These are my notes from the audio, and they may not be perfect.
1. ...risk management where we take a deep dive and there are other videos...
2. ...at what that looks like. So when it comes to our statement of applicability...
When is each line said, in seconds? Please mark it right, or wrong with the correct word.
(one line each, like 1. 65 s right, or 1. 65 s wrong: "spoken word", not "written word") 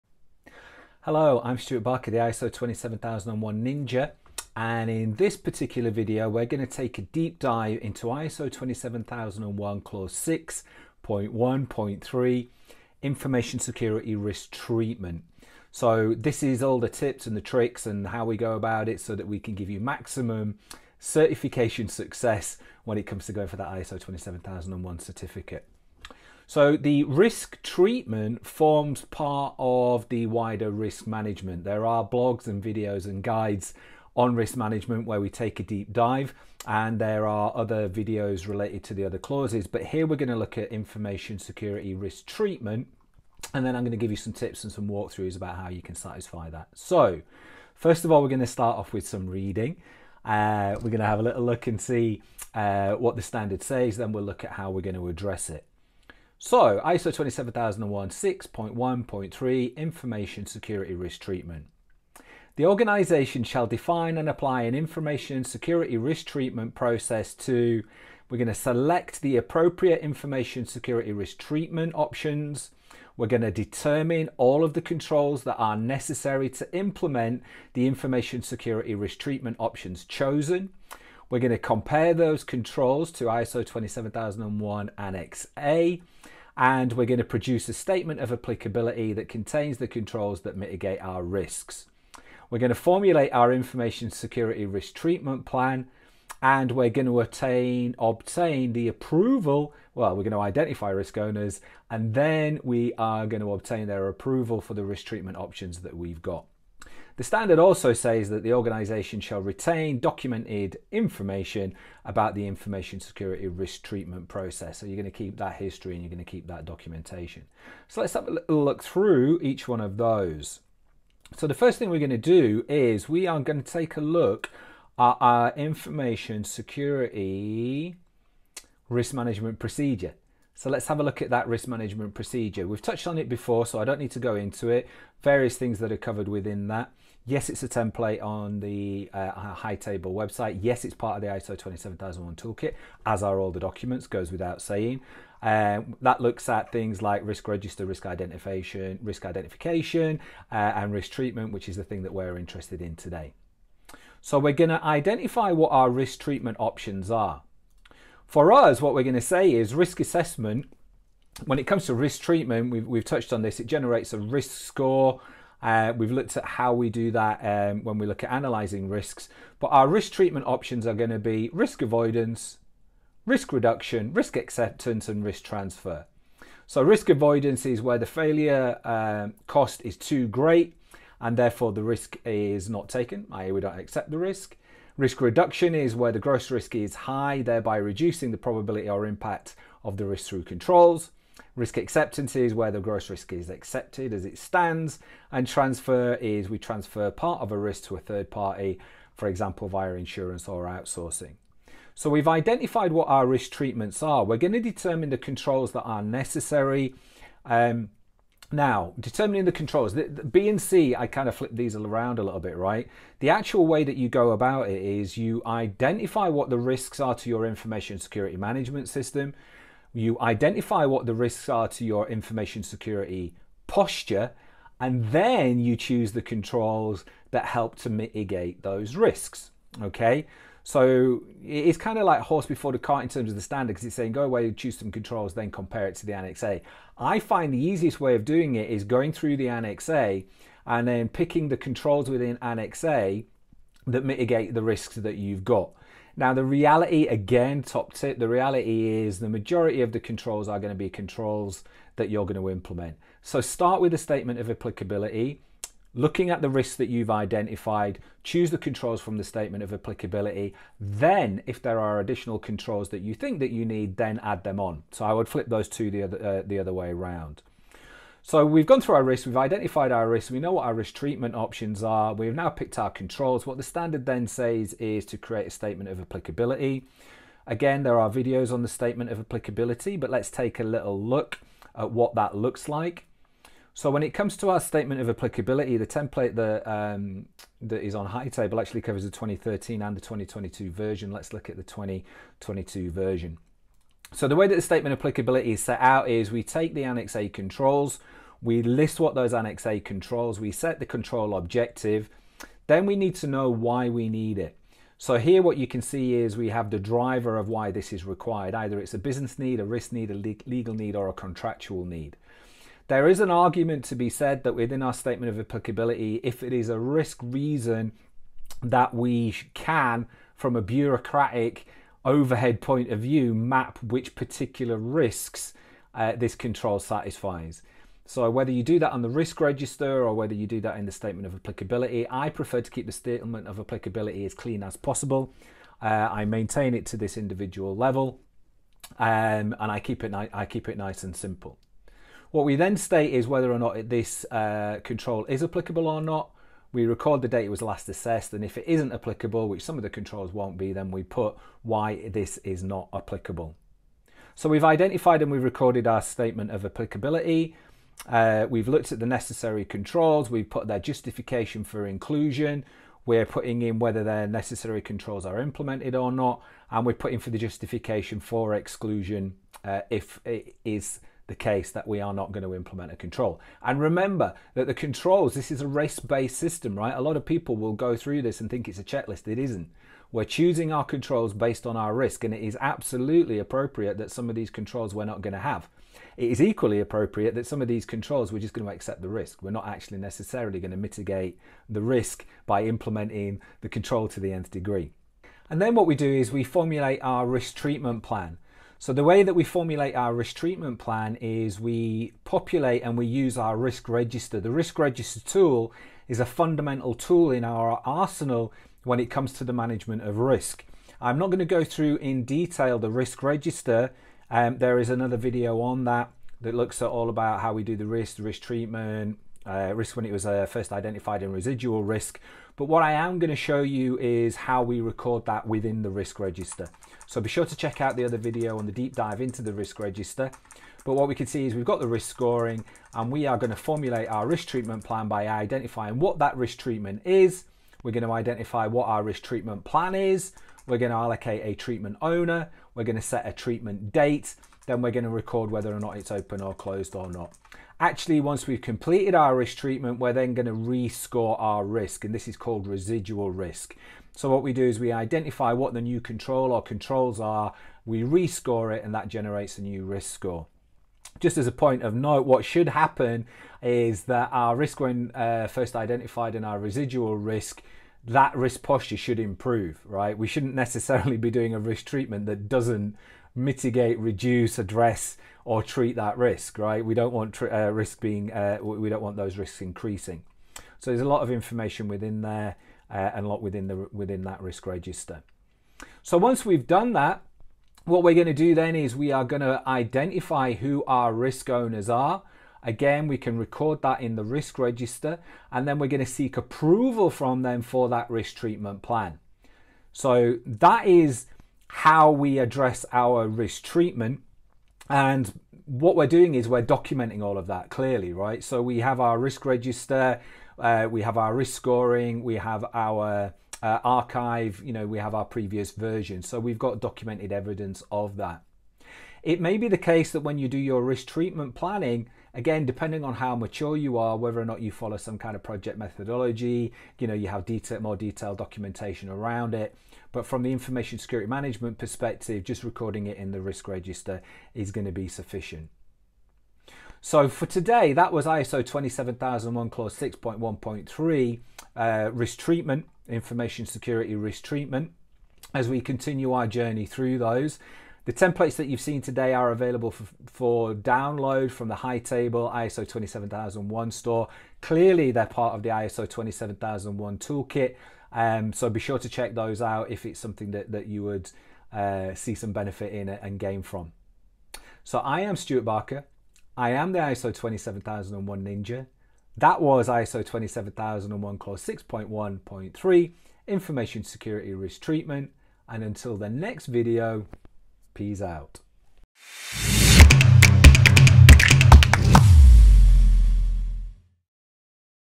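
1. 34 s right
2. 281 s right.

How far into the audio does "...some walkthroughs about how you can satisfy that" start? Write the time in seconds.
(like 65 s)
44 s.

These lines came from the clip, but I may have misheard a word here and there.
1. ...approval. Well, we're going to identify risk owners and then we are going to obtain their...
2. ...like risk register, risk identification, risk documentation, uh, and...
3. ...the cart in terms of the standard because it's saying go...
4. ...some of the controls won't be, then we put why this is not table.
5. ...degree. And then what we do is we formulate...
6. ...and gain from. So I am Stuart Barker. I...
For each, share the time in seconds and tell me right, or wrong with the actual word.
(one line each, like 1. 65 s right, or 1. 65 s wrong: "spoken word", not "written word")
1. 98 s right
2. 147 s wrong: "identification", not "documentation"
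3. 232 s right
4. 349 s wrong: "applicable", not "table"
5. 394 s right
6. 563 s right.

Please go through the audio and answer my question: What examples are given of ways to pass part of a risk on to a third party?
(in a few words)
insurance or outsourcing.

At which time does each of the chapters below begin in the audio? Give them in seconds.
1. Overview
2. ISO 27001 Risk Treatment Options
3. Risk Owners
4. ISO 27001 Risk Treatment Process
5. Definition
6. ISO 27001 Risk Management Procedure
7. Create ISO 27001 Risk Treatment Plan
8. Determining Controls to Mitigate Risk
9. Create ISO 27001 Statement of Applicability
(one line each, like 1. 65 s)
1. 30 s
2. 170 s
3. 490 s
4. 160 s
5. 56 s
6. 122 s
7. 396 s
8. 205 s
9. 275 s.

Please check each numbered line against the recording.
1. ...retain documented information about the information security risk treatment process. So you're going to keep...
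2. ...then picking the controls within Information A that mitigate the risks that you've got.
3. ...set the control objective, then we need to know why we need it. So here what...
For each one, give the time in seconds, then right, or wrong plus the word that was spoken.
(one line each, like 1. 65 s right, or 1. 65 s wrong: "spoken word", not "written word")
1. 109 s right
2. 240 s wrong: "Annex", not "Information"
3. 300 s right.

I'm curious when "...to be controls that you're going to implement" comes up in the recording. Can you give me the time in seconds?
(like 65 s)
250 s.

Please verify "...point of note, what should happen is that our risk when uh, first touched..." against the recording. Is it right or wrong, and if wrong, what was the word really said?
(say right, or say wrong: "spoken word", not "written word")
wrong: "identified", not "touched".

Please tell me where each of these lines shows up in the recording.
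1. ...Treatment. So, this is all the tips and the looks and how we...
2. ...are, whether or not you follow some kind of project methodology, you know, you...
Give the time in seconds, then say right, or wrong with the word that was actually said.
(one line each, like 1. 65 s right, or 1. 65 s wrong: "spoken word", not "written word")
1. 14 s wrong: "tricks", not "looks"
2. 523 s right.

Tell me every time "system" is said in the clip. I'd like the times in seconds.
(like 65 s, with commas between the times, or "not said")
218 s, 376 s.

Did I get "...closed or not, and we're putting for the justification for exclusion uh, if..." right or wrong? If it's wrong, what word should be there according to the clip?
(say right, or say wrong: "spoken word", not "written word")
wrong: "implemented", not "closed".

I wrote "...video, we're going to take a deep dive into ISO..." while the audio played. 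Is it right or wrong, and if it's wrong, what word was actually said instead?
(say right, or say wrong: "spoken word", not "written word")
right.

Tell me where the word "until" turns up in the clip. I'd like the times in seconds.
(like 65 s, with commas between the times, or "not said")
575 s.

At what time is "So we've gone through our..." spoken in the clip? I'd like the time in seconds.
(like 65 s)
268 s.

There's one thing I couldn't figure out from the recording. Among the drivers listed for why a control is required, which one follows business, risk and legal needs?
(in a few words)
contractual need.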